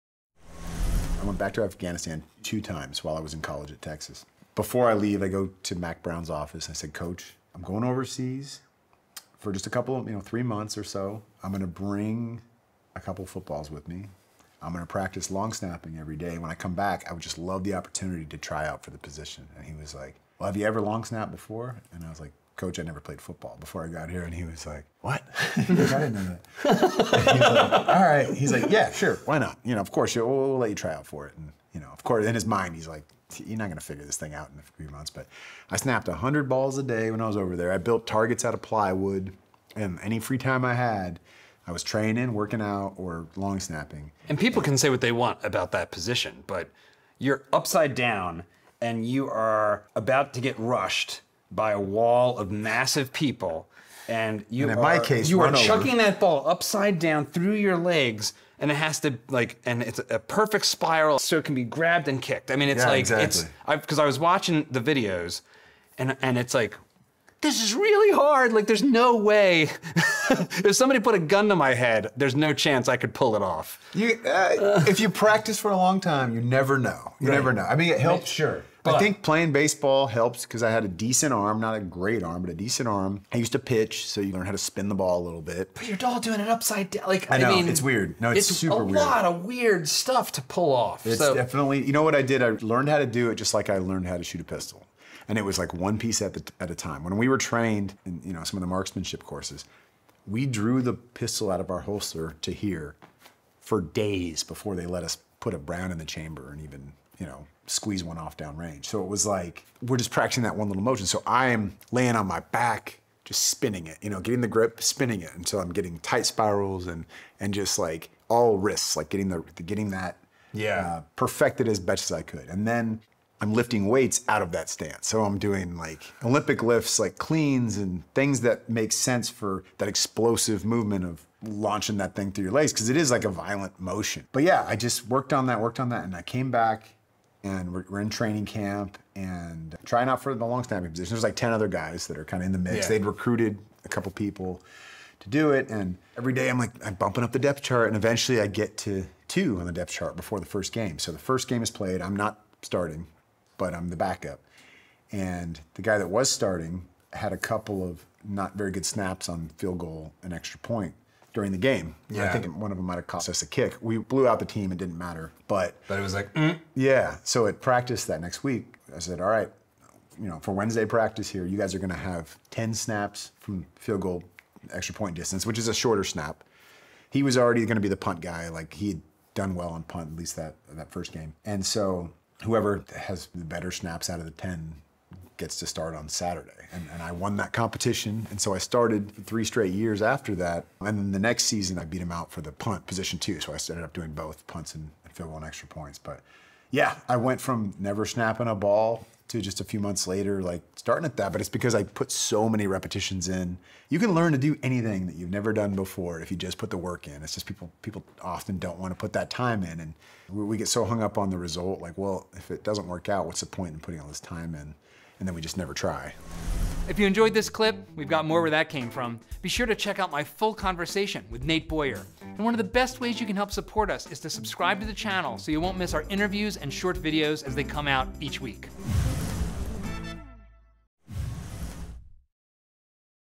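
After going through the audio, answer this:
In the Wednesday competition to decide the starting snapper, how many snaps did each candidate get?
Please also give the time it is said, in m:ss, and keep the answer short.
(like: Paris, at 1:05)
10, at 2:52.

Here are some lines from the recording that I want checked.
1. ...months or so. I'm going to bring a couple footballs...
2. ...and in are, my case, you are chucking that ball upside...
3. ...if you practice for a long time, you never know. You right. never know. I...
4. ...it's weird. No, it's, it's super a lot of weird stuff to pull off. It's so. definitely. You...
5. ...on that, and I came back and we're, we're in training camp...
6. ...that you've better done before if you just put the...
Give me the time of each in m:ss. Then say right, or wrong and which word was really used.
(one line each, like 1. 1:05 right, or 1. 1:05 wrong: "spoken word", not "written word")
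1. 0:10 right
2. 0:54 right
3. 1:14 right
4. 1:27 right
5. 2:15 right
6. 3:25 wrong: "never", not "better".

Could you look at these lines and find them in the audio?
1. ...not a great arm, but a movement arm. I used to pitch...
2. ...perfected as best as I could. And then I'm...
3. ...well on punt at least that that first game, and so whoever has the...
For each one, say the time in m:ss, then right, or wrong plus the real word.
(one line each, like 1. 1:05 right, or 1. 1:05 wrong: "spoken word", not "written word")
1. 1:21 wrong: "decent", not "movement"
2. 2:01 right
3. 2:59 right.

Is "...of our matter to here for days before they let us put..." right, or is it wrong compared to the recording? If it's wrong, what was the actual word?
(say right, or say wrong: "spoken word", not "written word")
wrong: "holster", not "matter".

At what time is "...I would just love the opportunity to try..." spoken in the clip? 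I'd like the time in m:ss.
0:17.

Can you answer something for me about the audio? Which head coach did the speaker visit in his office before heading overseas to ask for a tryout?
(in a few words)
Mack Brown.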